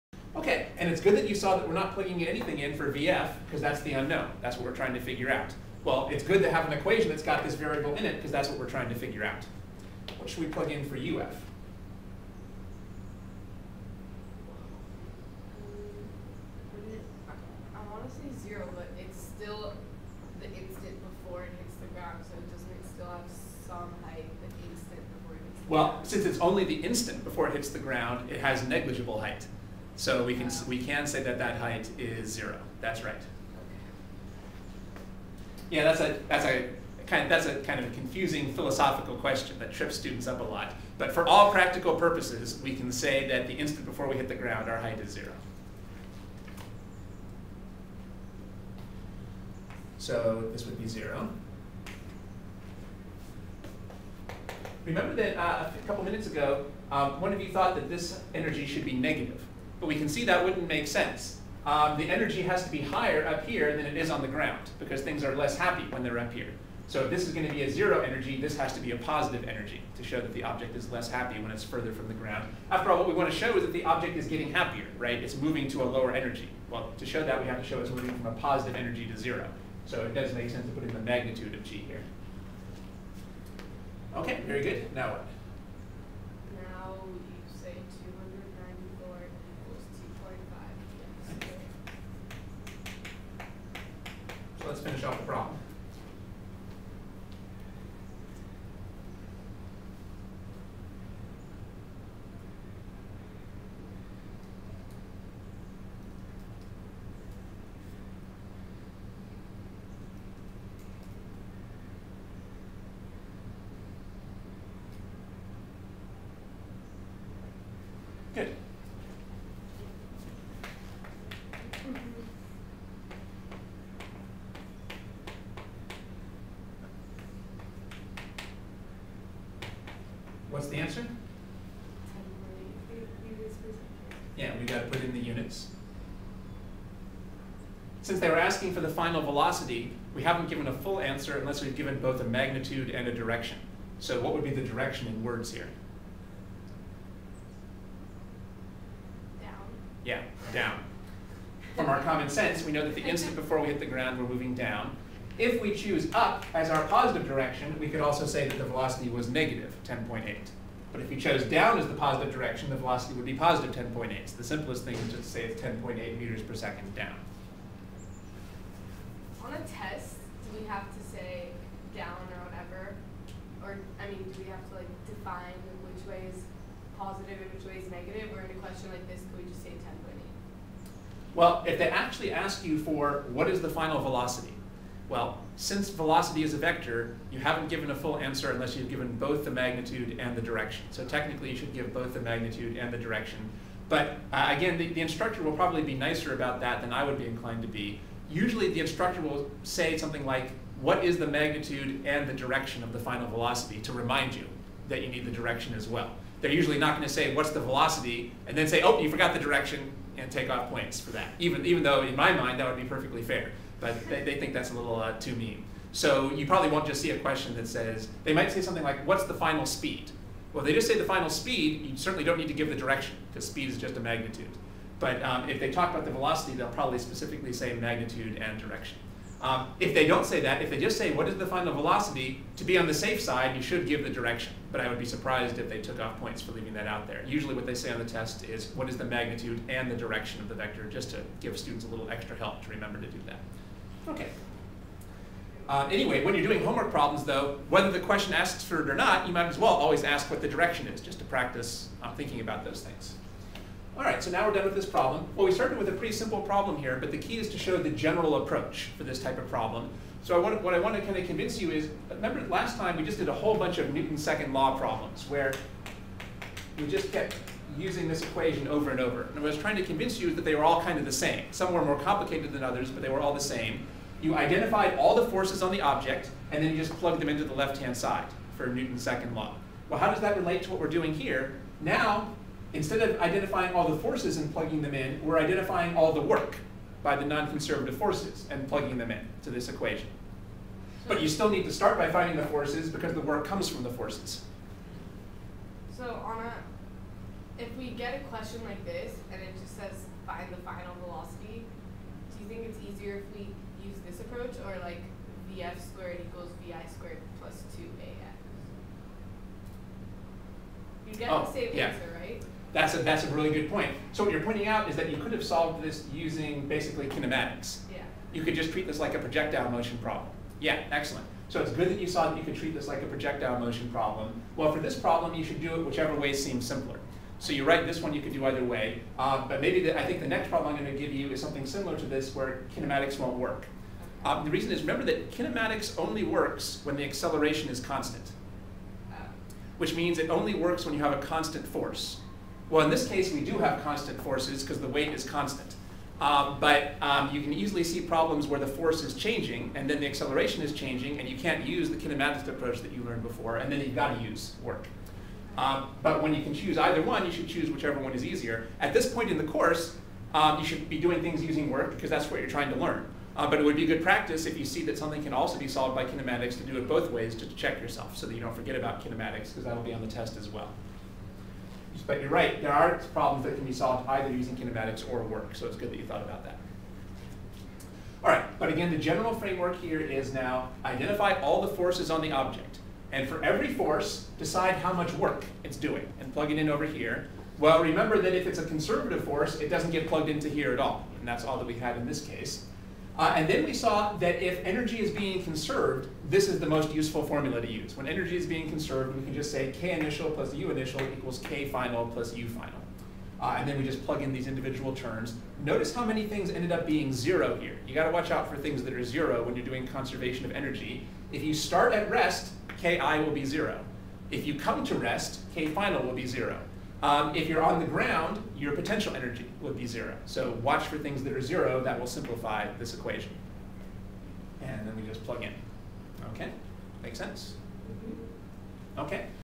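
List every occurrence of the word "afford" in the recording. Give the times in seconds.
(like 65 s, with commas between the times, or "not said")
not said.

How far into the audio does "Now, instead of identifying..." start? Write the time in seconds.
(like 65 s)
281 s.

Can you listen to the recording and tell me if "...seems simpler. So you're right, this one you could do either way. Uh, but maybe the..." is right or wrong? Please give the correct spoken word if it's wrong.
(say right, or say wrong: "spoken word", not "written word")
right.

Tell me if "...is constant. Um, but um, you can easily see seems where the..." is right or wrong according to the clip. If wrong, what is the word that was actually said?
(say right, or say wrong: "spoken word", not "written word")
wrong: "problems", not "seems".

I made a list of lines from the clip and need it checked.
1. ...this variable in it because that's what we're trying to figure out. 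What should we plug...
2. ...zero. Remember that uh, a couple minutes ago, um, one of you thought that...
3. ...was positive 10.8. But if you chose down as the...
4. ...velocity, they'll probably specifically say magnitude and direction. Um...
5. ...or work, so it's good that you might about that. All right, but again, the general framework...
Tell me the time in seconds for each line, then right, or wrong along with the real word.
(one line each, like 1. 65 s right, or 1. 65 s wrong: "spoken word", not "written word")
1. 7 s right
2. 50 s right
3. 159 s wrong: "negative", not "positive"
4. 226 s right
5. 375 s wrong: "thought", not "might".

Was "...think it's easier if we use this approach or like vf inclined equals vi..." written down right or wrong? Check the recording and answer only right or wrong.
wrong.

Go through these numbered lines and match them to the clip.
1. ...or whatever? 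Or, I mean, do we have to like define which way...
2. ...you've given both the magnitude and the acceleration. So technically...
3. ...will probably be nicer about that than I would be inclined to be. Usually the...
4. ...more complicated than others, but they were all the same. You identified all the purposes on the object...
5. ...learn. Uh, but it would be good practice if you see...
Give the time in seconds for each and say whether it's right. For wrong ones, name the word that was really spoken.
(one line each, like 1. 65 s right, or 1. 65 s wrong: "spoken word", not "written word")
1. 172 s right
2. 188 s wrong: "direction", not "acceleration"
3. 195 s right
4. 271 s wrong: "forces", not "purposes"
5. 362 s right.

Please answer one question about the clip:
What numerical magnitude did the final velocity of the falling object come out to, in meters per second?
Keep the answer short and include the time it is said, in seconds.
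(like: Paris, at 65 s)
10.8, at 165 s.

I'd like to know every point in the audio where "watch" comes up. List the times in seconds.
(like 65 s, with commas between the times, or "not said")
408 s, 420 s.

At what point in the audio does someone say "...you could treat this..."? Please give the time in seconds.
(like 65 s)
322 s.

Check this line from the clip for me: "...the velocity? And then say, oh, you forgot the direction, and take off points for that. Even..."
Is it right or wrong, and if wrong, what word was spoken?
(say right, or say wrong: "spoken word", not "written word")
right.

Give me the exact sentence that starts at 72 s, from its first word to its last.
After all, what we want to show is that the object is getting happier, right?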